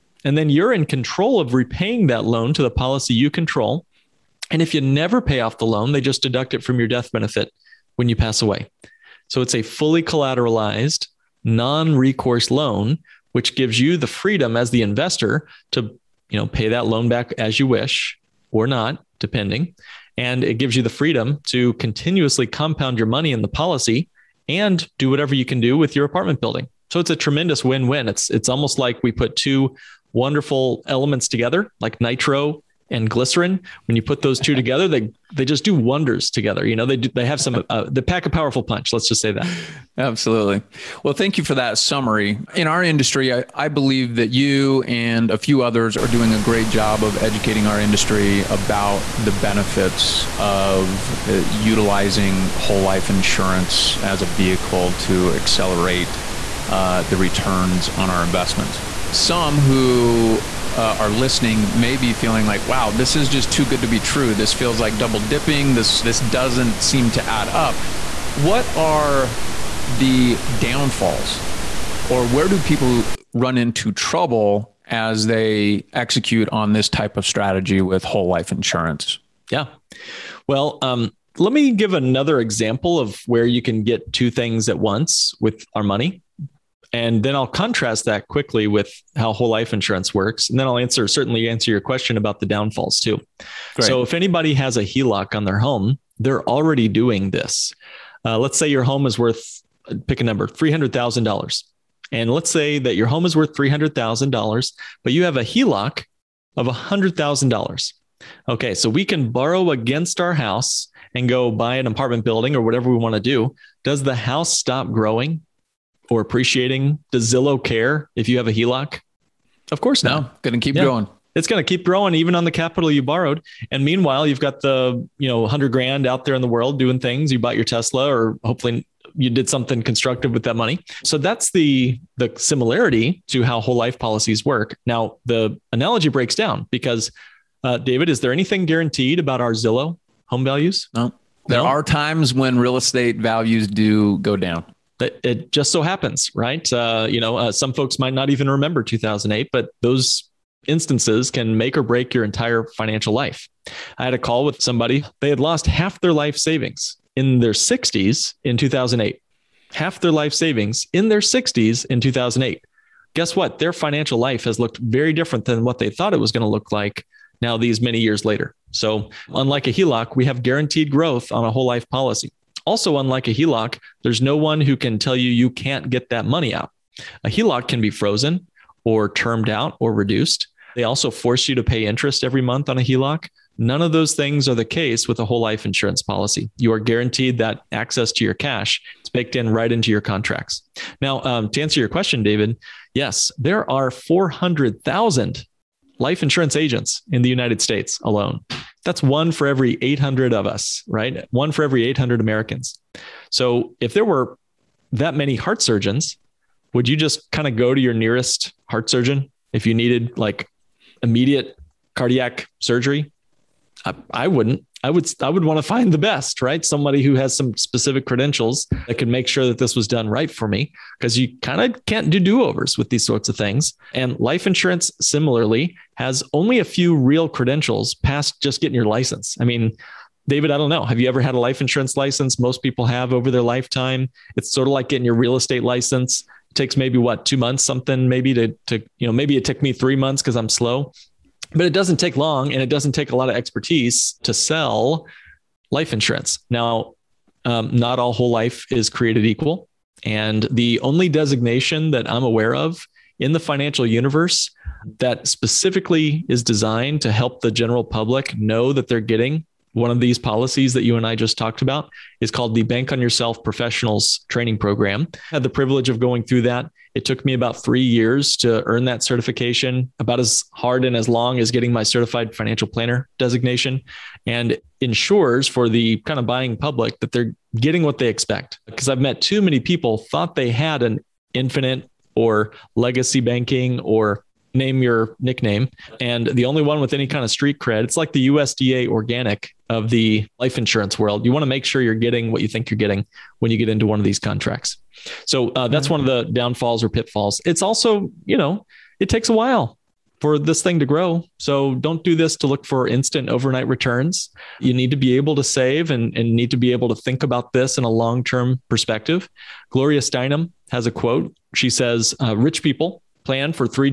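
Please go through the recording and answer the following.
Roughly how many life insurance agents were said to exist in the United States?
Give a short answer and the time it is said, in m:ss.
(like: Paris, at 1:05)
400,000, at 3:13.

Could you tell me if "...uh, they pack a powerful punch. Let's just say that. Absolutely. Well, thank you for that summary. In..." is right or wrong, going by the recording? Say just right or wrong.
right.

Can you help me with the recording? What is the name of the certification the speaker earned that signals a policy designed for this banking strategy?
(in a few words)
Bank on Yourself Professionals Training Program.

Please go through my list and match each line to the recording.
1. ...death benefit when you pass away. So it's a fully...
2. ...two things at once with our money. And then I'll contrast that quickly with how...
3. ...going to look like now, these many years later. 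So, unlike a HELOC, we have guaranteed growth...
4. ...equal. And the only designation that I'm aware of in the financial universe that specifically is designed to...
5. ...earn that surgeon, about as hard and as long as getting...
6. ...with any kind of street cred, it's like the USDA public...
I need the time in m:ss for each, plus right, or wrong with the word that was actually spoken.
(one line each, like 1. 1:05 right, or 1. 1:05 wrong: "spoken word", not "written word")
1. 0:06 right
2. 1:24 right
3. 2:46 right
4. 4:09 right
5. 4:28 wrong: "certification", not "surgeon"
6. 4:46 wrong: "organic", not "public".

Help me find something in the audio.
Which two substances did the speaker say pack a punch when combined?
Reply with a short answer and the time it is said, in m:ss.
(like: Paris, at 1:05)
nitro and glycerin, at 0:31.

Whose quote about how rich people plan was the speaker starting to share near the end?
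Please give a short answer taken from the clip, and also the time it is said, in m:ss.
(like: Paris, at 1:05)
Gloria Steinem, at 5:09.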